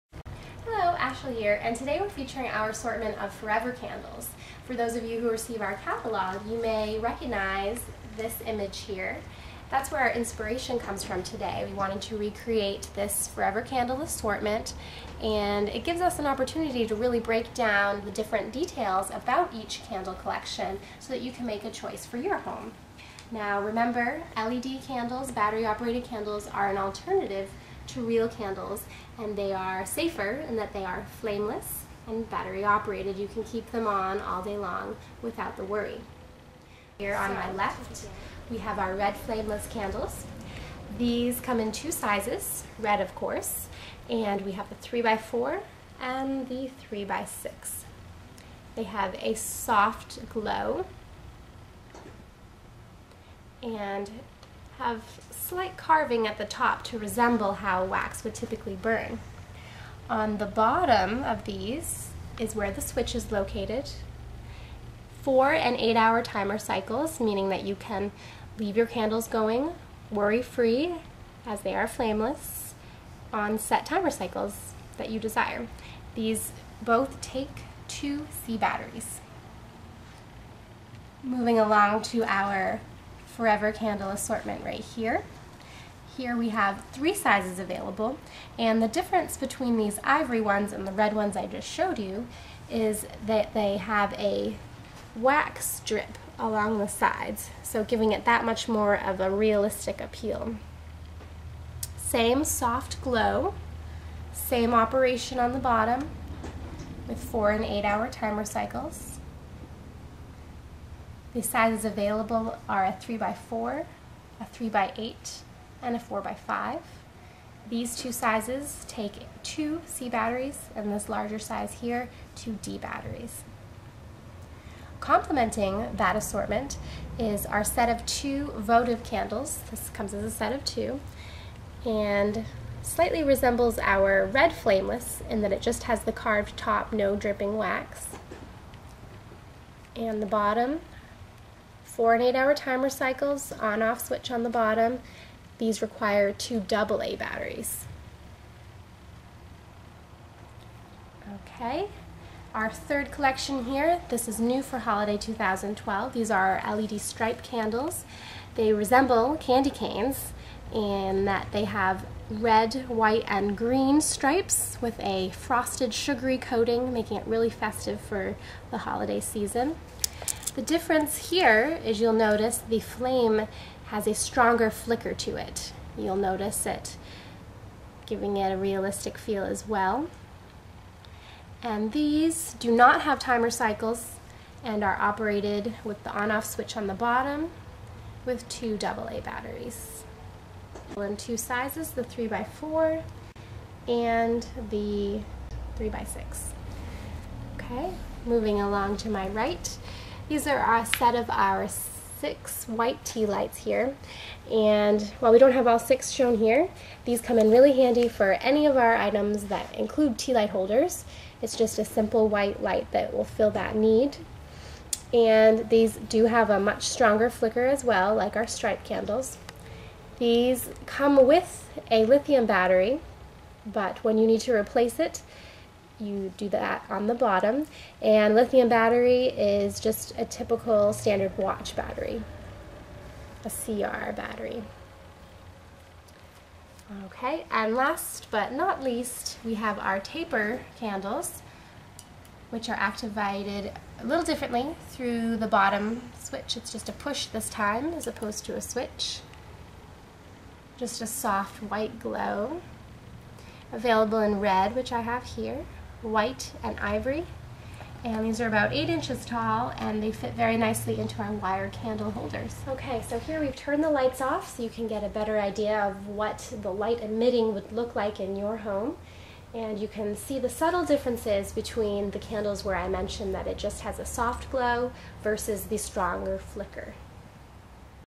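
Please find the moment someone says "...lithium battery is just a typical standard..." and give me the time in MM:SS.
03:48.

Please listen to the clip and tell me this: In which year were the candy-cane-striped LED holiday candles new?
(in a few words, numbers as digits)
2012.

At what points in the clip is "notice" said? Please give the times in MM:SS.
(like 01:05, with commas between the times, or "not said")
02:52, 02:56.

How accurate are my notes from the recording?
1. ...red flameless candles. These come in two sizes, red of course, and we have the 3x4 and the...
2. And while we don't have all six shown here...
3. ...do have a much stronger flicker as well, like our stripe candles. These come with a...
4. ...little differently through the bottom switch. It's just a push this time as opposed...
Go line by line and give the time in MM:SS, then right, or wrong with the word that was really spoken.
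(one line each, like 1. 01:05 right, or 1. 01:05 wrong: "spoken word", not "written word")
1. 00:38 right
2. 03:24 right
3. 03:35 right
4. 04:04 right.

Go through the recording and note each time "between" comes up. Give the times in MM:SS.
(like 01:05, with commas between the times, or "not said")
01:29, 04:31.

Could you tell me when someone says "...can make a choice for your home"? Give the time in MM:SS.
00:21.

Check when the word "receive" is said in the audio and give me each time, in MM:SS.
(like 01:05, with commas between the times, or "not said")
00:05.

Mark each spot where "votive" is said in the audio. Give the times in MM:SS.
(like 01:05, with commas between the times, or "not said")
02:08.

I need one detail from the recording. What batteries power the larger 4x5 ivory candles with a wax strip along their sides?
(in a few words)
2 D batteries.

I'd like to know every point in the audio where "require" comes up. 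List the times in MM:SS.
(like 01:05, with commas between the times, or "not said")
02:25.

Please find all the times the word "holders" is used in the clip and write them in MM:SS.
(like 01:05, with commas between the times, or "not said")
03:30, 04:22.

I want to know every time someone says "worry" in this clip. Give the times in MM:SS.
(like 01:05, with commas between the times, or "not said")
00:35, 01:10.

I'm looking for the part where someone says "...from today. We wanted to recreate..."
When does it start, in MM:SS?
00:11.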